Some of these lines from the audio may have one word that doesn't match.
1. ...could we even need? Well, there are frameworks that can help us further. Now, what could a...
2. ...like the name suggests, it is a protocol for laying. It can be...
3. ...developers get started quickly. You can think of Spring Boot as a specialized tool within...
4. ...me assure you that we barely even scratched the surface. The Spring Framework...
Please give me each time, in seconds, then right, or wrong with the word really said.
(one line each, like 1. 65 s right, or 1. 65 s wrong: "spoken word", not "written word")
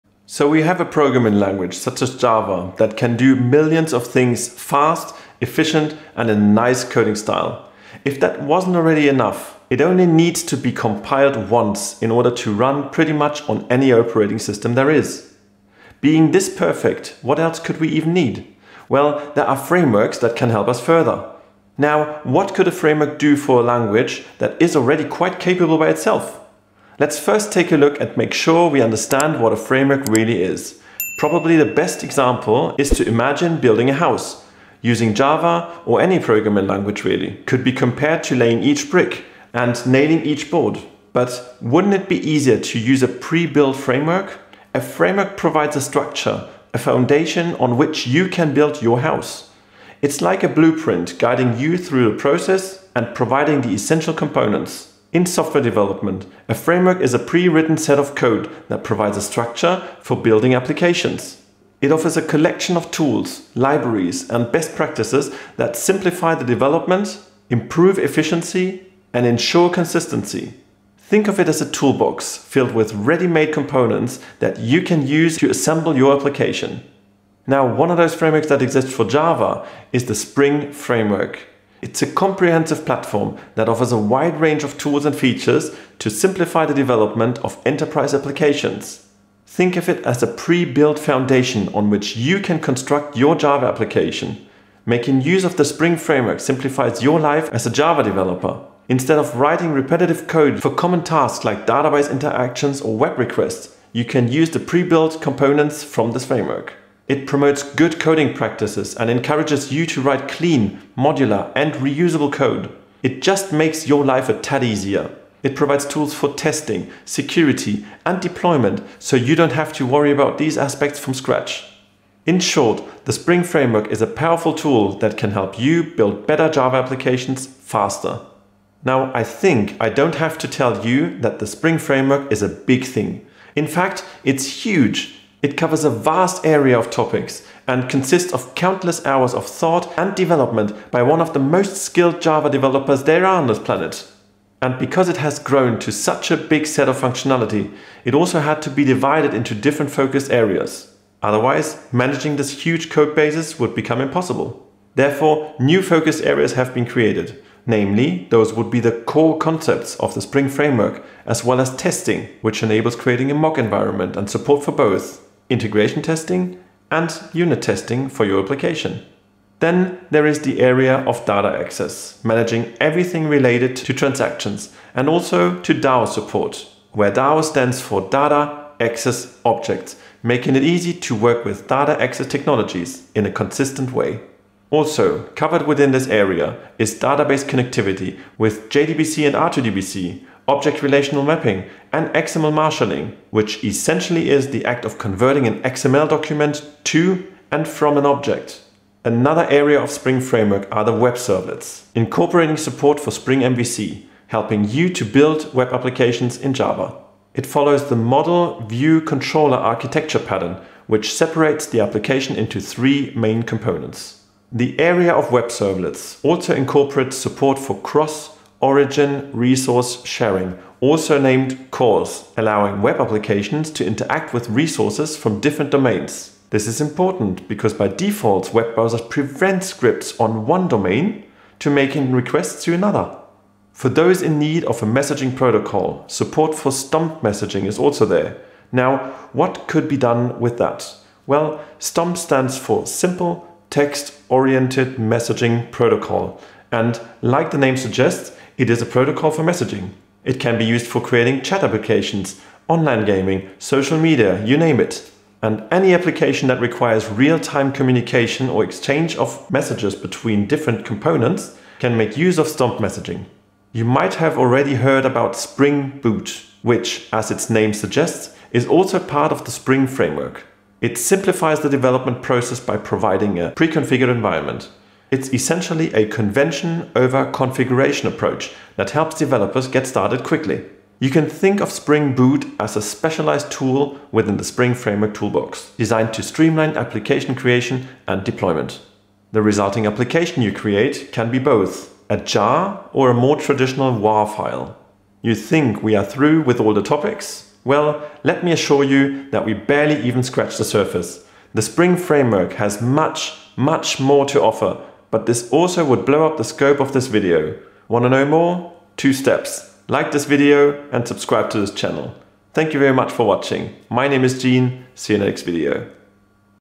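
1. 17 s right
2. 247 s wrong: "messaging", not "laying"
3. 279 s right
4. 298 s right.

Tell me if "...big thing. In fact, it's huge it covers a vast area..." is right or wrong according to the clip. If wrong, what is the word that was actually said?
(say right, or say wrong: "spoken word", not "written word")
right.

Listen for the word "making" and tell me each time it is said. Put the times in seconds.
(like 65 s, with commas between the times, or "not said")
94 s, 180 s, 231 s.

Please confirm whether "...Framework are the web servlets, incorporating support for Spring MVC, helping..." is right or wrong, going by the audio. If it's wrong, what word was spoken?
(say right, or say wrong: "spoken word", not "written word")
right.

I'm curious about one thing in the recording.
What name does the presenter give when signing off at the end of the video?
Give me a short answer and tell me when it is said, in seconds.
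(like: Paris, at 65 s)
Gene, at 314 s.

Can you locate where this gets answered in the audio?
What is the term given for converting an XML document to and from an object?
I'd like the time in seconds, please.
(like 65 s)
192 s.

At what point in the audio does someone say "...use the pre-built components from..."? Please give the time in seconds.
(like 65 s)
104 s.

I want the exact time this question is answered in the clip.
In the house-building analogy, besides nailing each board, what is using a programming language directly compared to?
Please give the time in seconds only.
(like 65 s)
38 s.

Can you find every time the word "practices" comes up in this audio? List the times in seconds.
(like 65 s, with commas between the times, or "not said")
64 s, 108 s.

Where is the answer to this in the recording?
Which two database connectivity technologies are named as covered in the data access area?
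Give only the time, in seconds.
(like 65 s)
188 s.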